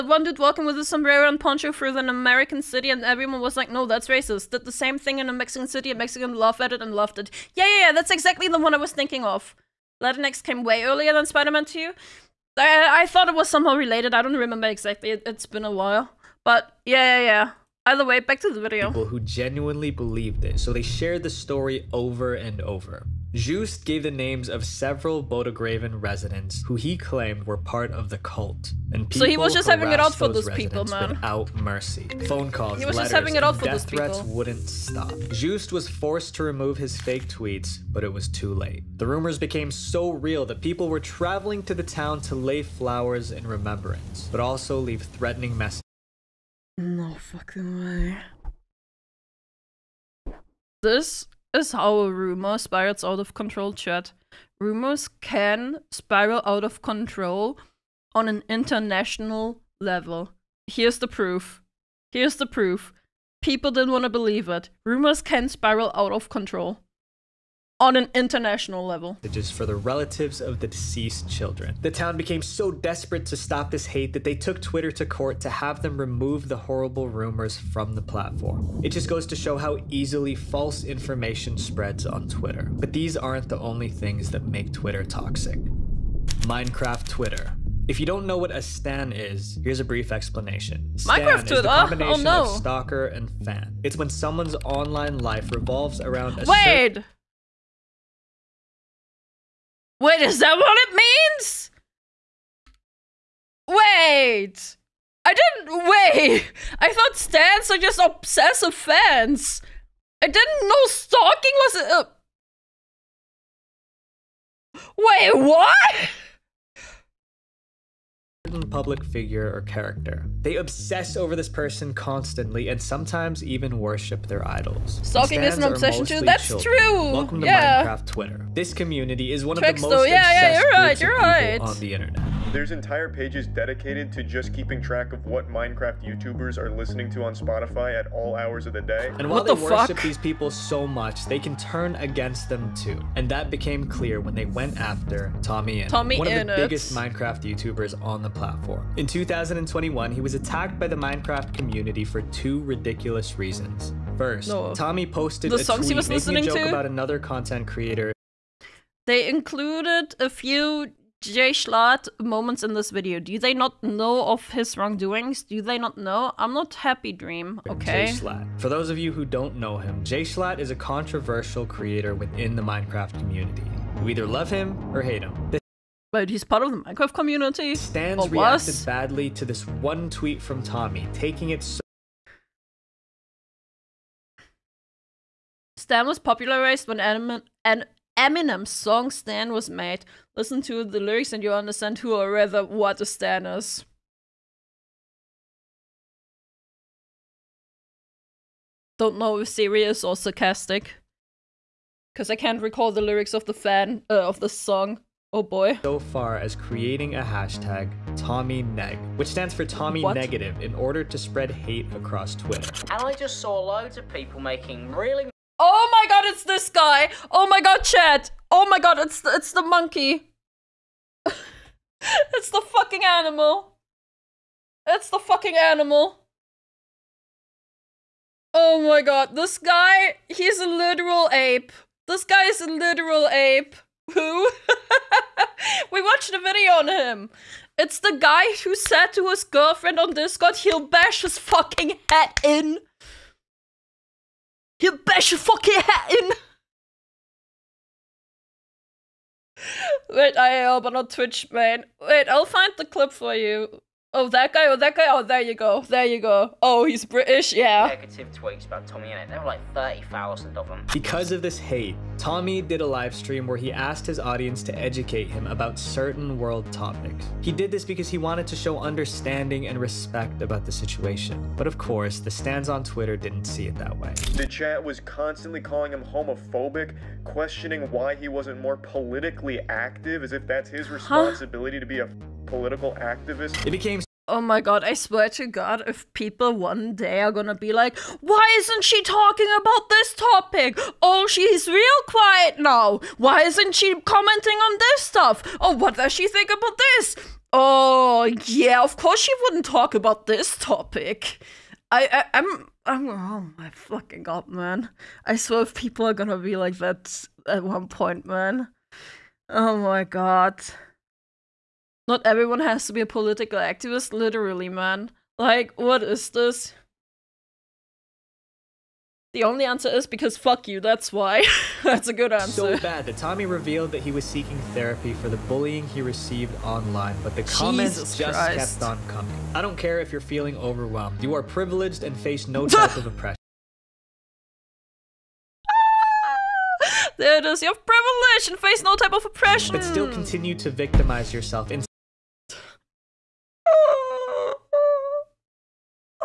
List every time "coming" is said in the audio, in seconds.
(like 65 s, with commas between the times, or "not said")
329 s.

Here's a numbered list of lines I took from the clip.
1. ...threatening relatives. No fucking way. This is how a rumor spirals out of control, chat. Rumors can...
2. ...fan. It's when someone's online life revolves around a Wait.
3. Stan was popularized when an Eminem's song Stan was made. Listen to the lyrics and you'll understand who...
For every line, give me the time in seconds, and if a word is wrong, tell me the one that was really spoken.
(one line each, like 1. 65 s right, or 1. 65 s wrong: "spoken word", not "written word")
1. 45 s wrong: "messages", not "relatives"
2. 93 s right
3. 185 s right.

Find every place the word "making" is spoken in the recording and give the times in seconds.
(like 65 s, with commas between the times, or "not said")
156 s, 214 s.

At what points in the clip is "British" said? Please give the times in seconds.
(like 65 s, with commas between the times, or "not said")
257 s.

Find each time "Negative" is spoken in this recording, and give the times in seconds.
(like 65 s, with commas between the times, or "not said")
210 s, 257 s.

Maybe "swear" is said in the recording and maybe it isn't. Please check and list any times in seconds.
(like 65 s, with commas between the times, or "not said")
284 s, 305 s.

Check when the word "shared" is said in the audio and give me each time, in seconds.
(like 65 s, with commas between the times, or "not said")
20 s.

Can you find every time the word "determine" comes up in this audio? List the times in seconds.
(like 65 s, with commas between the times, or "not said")
not said.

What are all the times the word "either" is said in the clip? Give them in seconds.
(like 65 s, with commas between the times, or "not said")
17 s, 174 s.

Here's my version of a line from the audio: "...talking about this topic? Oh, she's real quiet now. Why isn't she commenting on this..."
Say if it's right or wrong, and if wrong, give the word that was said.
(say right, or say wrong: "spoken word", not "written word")
right.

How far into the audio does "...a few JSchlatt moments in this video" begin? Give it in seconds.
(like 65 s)
160 s.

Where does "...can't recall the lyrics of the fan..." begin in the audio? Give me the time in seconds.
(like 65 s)
202 s.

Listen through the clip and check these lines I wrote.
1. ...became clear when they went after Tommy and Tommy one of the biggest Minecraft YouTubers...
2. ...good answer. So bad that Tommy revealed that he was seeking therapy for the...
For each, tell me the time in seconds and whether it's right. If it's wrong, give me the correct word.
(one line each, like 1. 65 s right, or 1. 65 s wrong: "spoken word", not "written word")
1. 143 s right
2. 322 s right.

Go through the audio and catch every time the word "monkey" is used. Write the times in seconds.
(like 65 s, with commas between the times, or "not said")
219 s.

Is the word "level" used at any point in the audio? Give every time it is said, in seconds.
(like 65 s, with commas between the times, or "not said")
59 s, 68 s.